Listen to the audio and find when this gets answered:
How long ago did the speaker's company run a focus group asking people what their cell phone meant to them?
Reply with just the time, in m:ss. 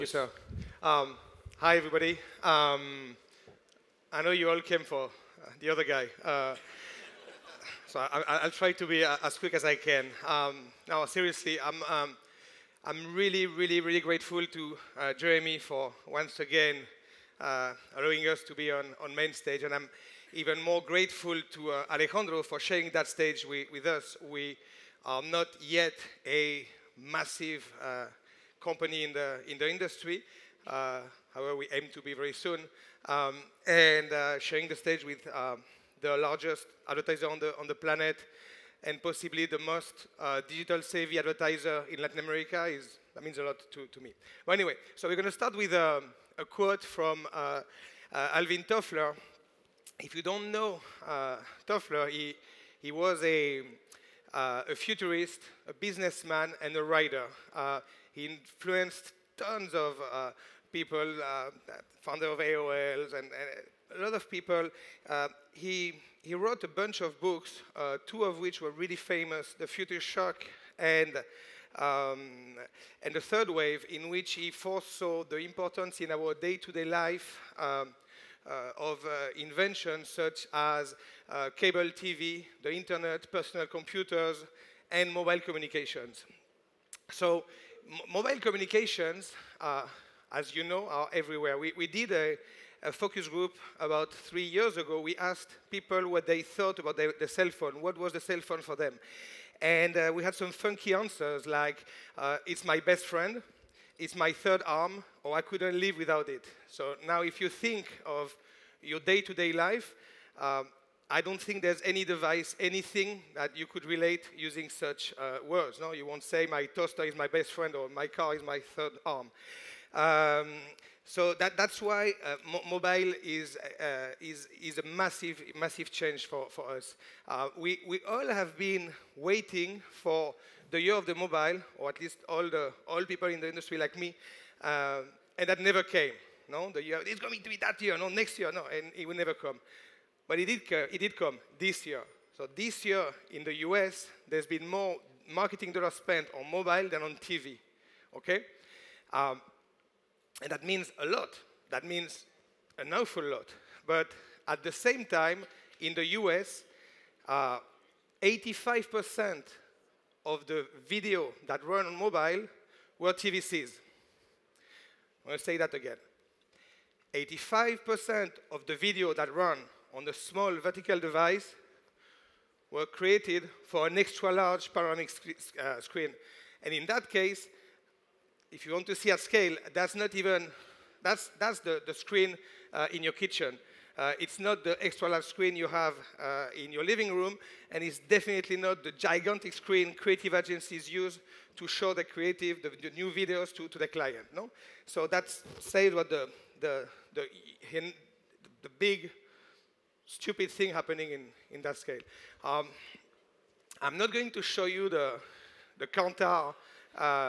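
1:34.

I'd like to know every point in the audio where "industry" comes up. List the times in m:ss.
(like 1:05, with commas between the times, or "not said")
0:29, 2:13.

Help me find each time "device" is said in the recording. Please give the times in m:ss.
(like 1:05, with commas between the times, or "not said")
1:52, 2:50.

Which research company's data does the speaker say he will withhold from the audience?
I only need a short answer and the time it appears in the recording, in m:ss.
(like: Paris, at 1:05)
Kantar, at 3:25.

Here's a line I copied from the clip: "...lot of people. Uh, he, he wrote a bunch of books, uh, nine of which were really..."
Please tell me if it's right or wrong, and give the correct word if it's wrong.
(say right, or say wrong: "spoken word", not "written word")
wrong: "two", not "nine".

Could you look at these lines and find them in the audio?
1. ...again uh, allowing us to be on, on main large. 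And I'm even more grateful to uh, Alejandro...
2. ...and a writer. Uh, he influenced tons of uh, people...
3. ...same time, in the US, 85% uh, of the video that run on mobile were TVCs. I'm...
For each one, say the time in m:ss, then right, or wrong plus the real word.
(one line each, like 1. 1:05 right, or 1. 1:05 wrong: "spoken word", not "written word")
1. 0:16 wrong: "stage", not "large"
2. 0:56 right
3. 2:34 right.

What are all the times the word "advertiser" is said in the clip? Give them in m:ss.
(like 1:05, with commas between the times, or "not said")
0:36, 0:41.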